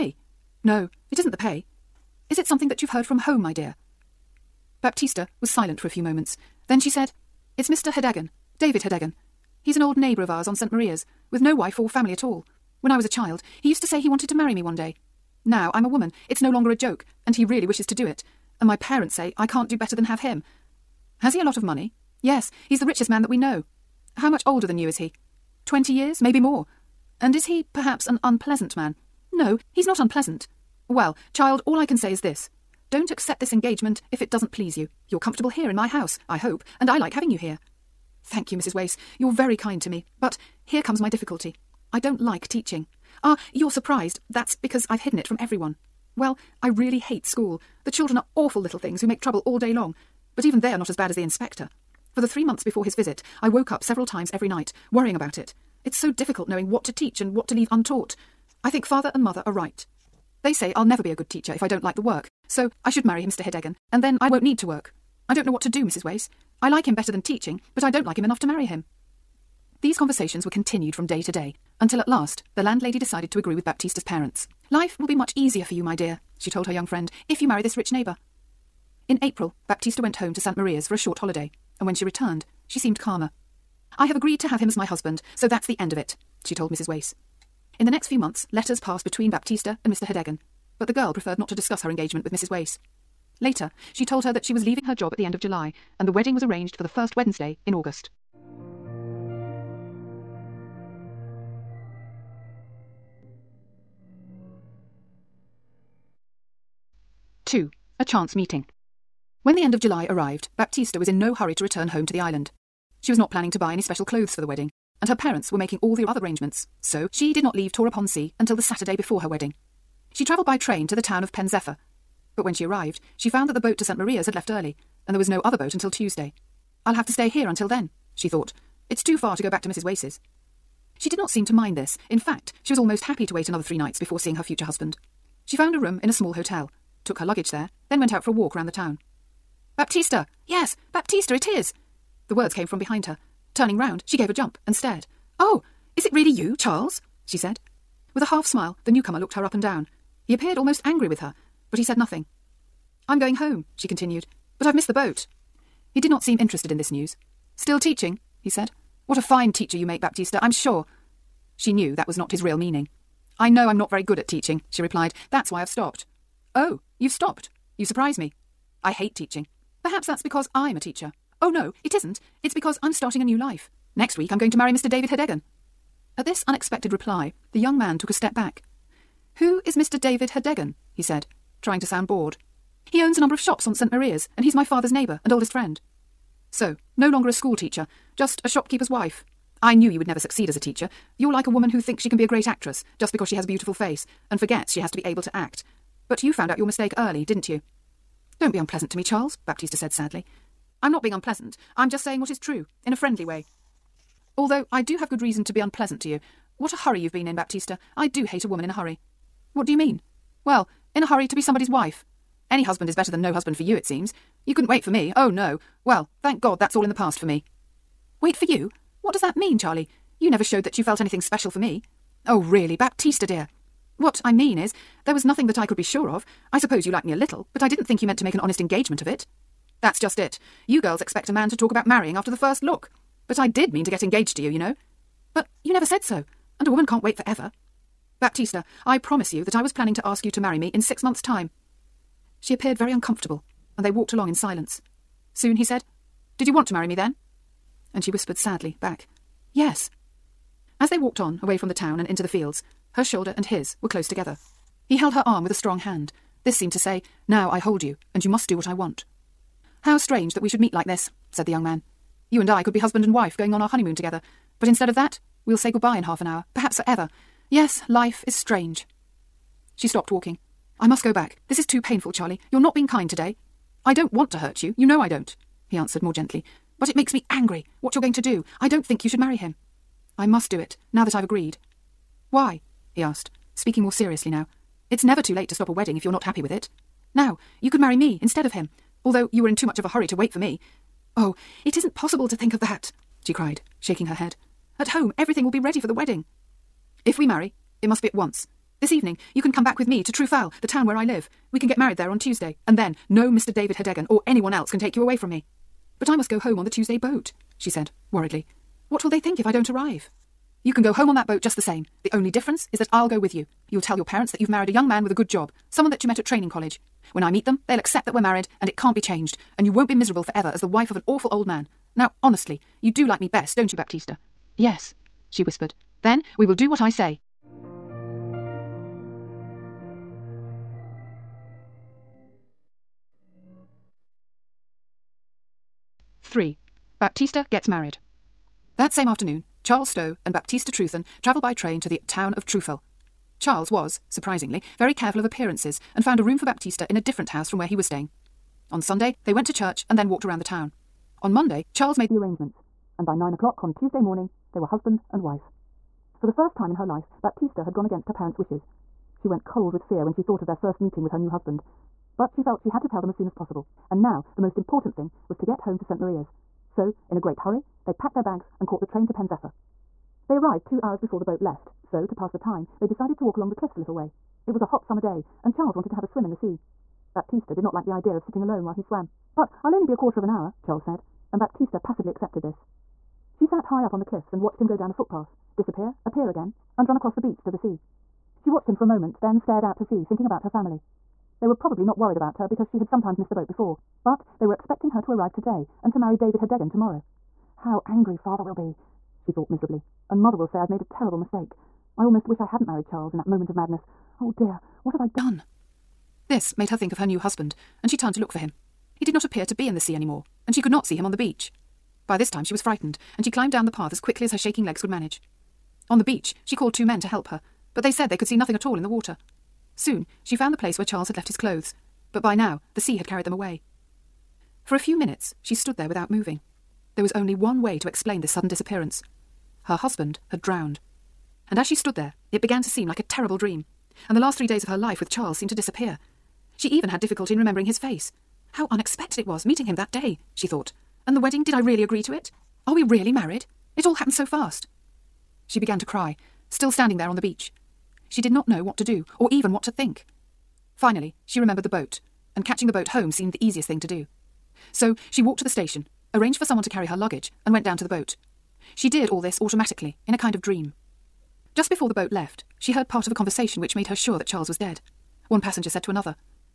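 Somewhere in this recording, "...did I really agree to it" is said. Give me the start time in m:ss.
7:21.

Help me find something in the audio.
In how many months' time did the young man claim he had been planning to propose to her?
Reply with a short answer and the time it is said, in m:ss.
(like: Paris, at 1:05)
6, at 4:00.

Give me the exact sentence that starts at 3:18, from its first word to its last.
Don't be unpleasant to me, Charles, Baptista said sadly.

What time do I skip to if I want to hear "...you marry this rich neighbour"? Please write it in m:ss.
1:17.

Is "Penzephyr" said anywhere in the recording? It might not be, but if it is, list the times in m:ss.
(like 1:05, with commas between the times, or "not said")
2:01, 6:09.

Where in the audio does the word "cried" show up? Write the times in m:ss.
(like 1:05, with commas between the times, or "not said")
4:53.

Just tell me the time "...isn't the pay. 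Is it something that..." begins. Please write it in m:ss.
0:01.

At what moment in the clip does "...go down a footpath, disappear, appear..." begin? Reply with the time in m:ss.
6:24.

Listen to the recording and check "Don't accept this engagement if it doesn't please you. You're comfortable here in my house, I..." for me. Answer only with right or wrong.
right.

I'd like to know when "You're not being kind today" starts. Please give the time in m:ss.
4:32.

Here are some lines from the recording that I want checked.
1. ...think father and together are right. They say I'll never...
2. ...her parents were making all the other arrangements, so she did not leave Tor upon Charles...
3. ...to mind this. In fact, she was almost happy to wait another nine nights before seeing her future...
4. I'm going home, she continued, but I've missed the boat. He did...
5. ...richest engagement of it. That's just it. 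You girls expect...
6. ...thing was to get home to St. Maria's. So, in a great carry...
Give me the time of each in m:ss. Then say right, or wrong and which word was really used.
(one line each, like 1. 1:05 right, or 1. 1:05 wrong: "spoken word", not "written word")
1. 0:58 wrong: "mother", not "together"
2. 1:55 wrong: "Sea", not "Charles"
3. 2:11 wrong: "three", not "nine"
4. 2:33 right
5. 3:48 wrong: "honest", not "richest"
6. 6:04 wrong: "hurry", not "carry".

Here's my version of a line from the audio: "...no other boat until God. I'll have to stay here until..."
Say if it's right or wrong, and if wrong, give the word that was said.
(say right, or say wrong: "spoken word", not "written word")
wrong: "Tuesday", not "God".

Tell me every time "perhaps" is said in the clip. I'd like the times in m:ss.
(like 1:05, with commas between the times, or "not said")
0:27, 2:49, 4:26.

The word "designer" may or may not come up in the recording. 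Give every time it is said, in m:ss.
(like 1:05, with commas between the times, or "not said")
not said.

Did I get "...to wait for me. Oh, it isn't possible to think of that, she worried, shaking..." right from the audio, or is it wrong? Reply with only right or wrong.
wrong.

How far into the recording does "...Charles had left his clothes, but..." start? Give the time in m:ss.
7:00.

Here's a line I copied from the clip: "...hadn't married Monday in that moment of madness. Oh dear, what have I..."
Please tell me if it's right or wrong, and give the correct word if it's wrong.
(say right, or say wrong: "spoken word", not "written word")
wrong: "Charles", not "Monday".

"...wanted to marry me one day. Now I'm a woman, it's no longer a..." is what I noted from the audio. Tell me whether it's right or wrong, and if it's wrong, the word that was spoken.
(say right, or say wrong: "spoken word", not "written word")
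right.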